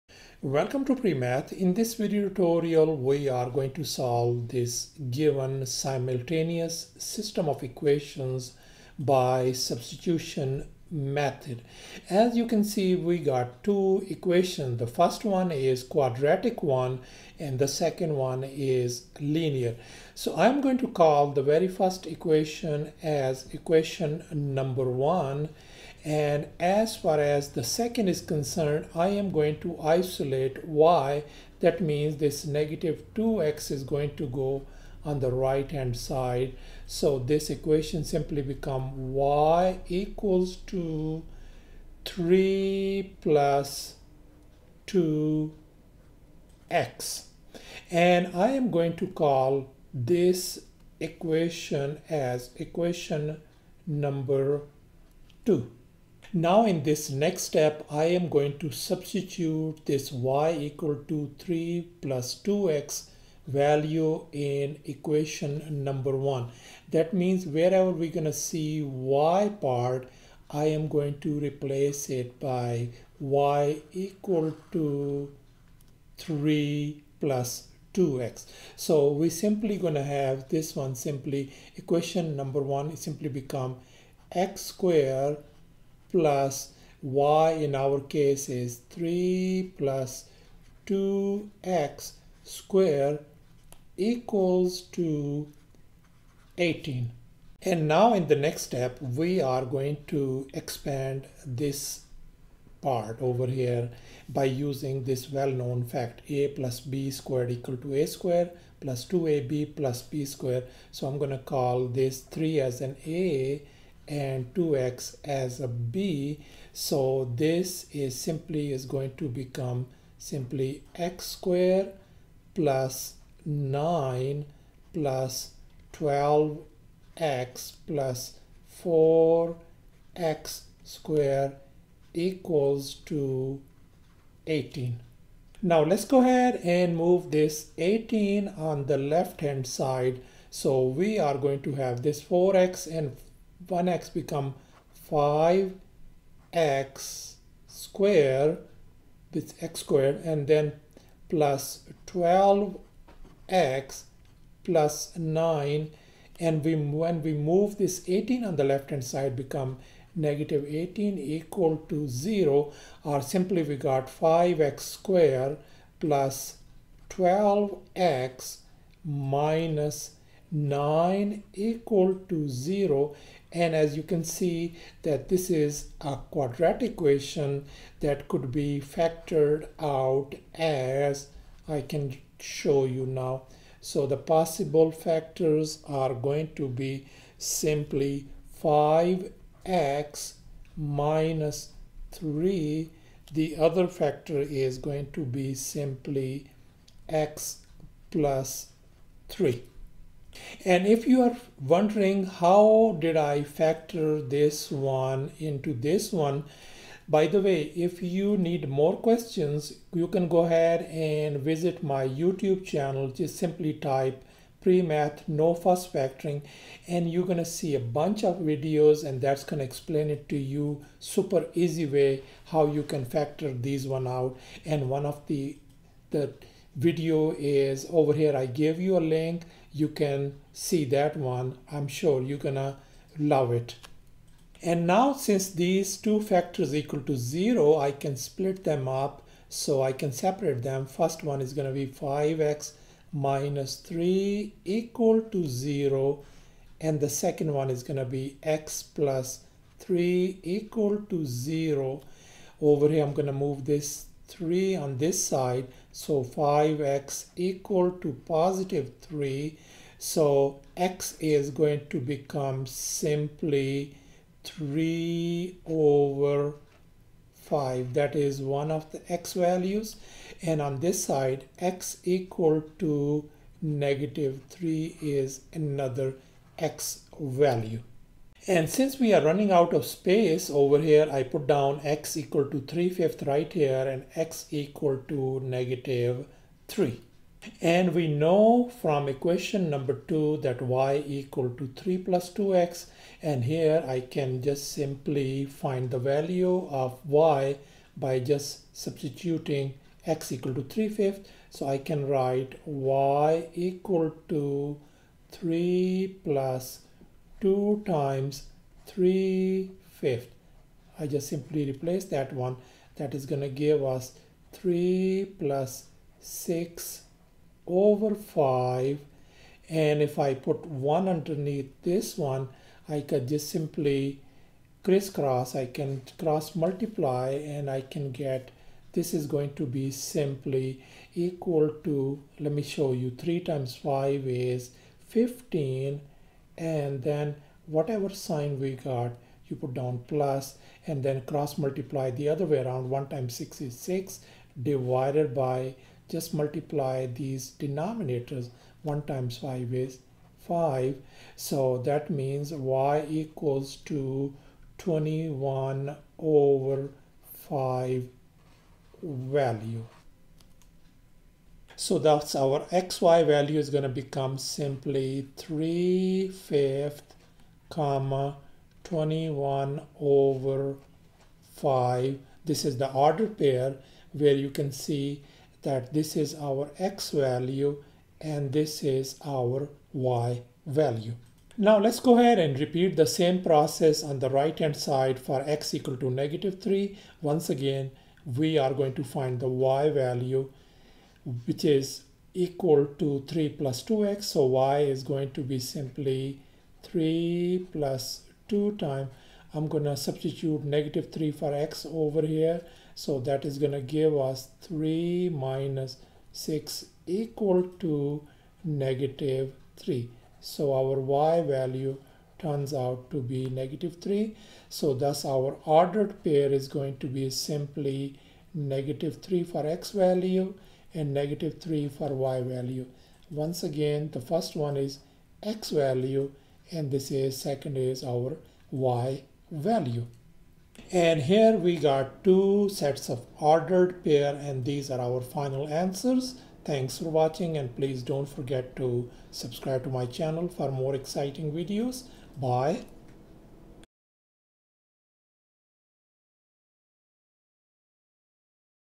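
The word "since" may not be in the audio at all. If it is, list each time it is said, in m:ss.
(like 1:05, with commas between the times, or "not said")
3:55, 4:38.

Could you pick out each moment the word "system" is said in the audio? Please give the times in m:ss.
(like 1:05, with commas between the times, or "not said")
0:06.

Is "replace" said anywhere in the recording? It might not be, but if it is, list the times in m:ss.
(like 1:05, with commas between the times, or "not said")
1:11, 5:11.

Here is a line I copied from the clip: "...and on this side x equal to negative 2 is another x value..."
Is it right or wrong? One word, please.
wrong.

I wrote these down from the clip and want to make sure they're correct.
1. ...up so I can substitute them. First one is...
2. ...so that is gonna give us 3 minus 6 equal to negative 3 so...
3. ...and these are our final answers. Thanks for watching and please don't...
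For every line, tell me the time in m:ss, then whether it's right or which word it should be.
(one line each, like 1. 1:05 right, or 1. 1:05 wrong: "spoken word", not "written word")
1. 3:58 wrong: "separate", not "substitute"
2. 6:42 right
3. 7:14 right.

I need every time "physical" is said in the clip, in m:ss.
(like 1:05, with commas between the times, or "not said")
not said.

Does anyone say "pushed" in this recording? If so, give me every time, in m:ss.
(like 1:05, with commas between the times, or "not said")
not said.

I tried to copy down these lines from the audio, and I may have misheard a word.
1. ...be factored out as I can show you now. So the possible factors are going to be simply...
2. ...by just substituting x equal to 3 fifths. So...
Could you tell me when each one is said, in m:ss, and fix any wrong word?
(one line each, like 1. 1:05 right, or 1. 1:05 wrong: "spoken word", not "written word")
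1. 2:58 right
2. 4:57 right.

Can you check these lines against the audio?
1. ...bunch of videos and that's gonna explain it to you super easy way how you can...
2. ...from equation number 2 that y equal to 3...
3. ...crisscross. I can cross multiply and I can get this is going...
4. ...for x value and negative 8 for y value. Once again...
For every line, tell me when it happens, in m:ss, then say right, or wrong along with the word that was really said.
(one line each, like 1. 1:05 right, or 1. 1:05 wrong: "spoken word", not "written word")
1. 3:37 right
2. 4:48 right
3. 5:24 right
4. 6:59 wrong: "3", not "8".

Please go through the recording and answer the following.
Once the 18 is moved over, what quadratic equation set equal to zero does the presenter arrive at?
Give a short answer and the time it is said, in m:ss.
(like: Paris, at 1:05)
5x² + 12x - 9 = 0, at 2:44.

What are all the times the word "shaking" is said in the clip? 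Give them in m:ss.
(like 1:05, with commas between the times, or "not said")
not said.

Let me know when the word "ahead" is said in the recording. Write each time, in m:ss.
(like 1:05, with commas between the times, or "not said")
2:16, 3:30, 6:22.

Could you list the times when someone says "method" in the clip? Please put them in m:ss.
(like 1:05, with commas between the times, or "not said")
0:10.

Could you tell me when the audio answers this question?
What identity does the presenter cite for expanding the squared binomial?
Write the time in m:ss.
1:47.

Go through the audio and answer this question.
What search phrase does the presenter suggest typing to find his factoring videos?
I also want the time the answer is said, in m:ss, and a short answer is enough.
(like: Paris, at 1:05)
pre-math, no fuss factoring, at 3:34.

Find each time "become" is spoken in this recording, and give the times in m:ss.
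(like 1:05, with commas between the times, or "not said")
0:38, 1:23, 1:59, 2:24, 2:39, 4:22, 6:04.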